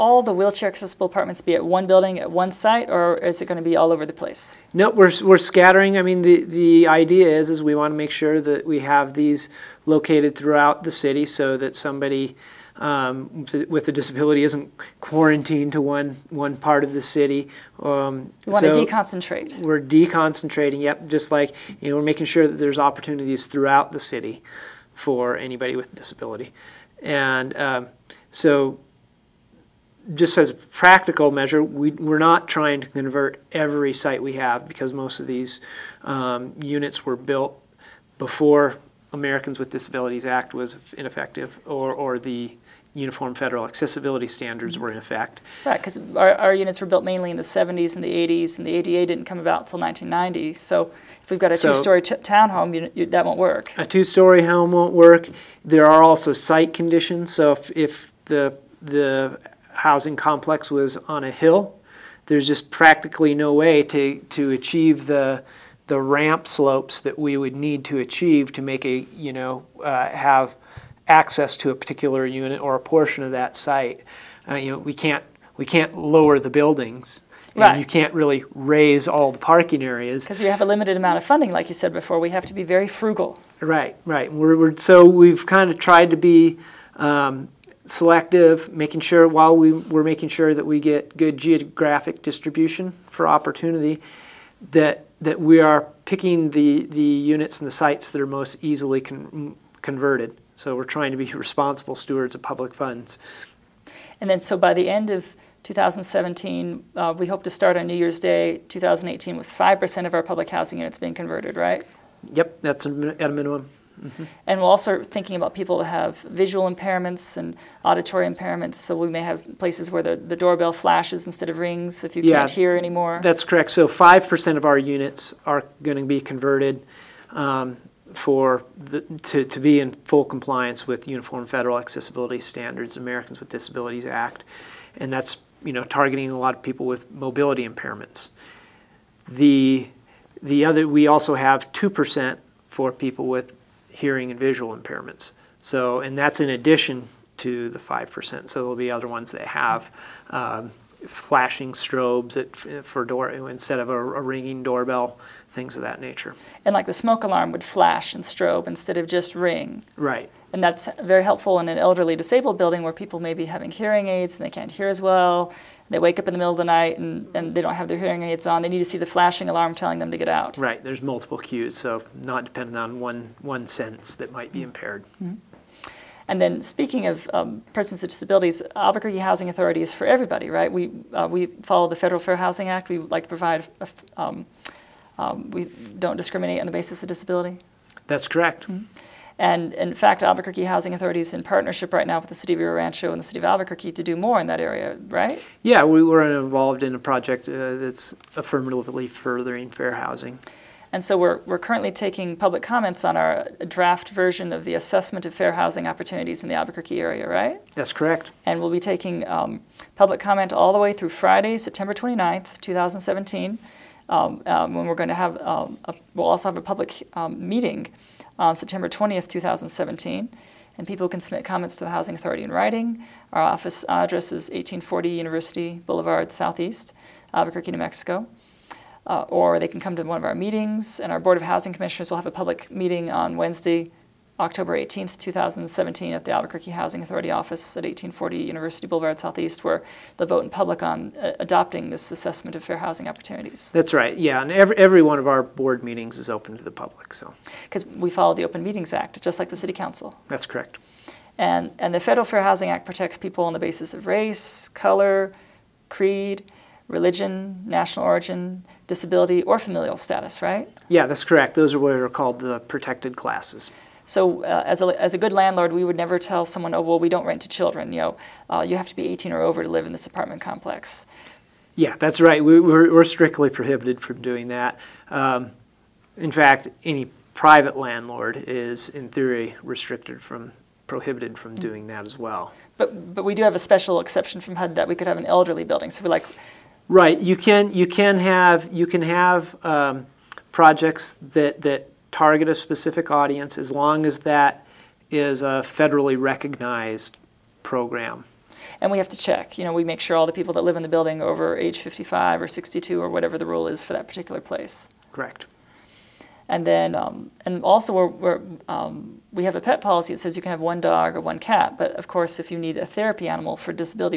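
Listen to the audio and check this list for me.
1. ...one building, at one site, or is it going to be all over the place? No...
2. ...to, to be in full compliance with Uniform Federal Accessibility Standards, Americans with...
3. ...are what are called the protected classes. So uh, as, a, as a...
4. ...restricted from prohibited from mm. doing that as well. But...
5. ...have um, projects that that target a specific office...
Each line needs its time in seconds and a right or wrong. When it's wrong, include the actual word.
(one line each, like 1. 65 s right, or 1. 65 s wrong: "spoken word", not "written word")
1. 1 s right
2. 129 s right
3. 261 s right
4. 279 s right
5. 289 s wrong: "audience", not "office".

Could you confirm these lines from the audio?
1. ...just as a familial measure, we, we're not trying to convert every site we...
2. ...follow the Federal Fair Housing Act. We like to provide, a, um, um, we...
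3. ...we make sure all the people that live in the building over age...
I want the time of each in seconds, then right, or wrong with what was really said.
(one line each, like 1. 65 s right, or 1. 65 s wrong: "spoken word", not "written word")
1. 30 s wrong: "practical", not "familial"
2. 181 s right
3. 299 s right.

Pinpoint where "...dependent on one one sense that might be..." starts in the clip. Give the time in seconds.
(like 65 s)
172 s.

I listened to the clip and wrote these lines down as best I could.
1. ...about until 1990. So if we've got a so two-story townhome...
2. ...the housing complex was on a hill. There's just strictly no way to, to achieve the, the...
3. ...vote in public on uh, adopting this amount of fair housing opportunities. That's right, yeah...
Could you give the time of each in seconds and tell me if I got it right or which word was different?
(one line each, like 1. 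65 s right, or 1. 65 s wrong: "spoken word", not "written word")
1. 49 s right
2. 58 s wrong: "practically", not "strictly"
3. 240 s wrong: "assessment", not "amount".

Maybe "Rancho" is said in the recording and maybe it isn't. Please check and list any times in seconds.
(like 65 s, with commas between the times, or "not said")
192 s.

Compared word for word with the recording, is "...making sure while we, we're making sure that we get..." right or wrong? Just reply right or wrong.
right.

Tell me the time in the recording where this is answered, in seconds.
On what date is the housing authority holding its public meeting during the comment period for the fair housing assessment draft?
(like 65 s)
218 s.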